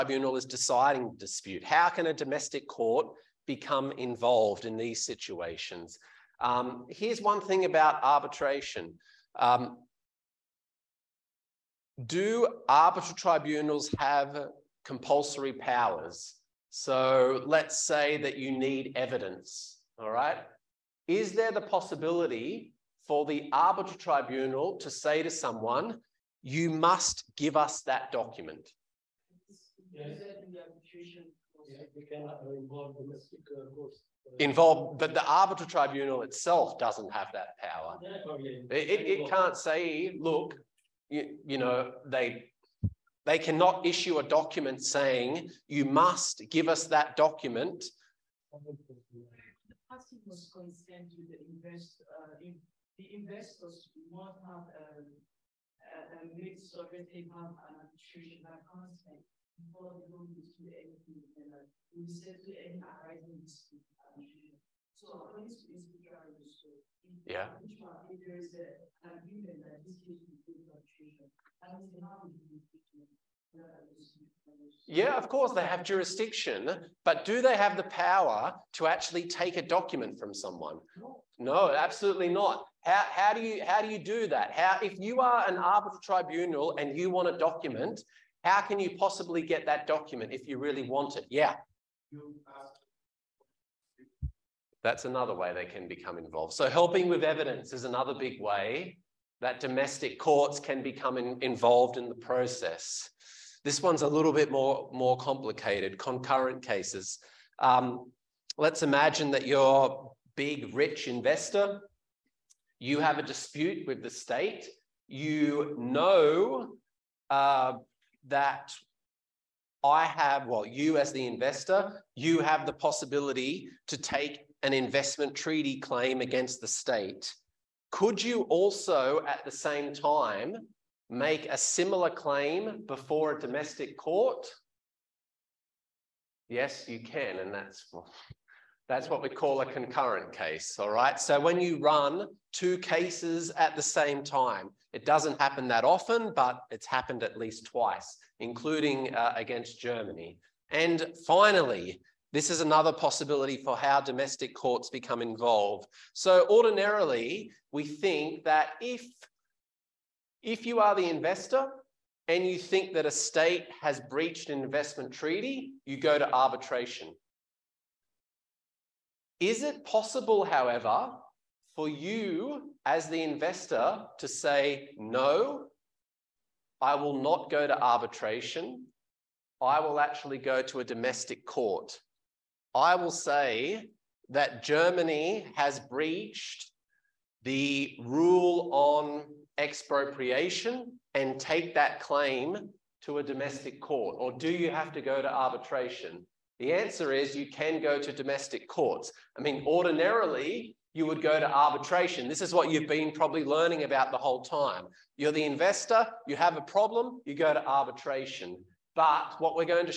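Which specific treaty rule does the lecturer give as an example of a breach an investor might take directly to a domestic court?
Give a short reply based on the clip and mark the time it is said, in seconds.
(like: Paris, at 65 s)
expropriation, at 189 s.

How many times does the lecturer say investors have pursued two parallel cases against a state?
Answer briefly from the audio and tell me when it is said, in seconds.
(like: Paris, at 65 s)
at least twice, at 147 s.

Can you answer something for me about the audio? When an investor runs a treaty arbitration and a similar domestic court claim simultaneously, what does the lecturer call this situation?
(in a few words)
concurrent case.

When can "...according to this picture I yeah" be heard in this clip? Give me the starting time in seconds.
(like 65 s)
65 s.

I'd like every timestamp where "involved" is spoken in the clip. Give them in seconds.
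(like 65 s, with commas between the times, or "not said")
3 s, 34 s, 96 s, 101 s, 155 s.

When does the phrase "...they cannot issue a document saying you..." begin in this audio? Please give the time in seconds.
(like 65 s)
43 s.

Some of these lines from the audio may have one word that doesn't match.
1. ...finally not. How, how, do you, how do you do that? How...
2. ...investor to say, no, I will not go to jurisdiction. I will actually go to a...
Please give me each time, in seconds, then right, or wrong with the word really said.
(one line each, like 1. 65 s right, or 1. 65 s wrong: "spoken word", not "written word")
1. 81 s wrong: "absolutely", not "finally"
2. 173 s wrong: "arbitration", not "jurisdiction".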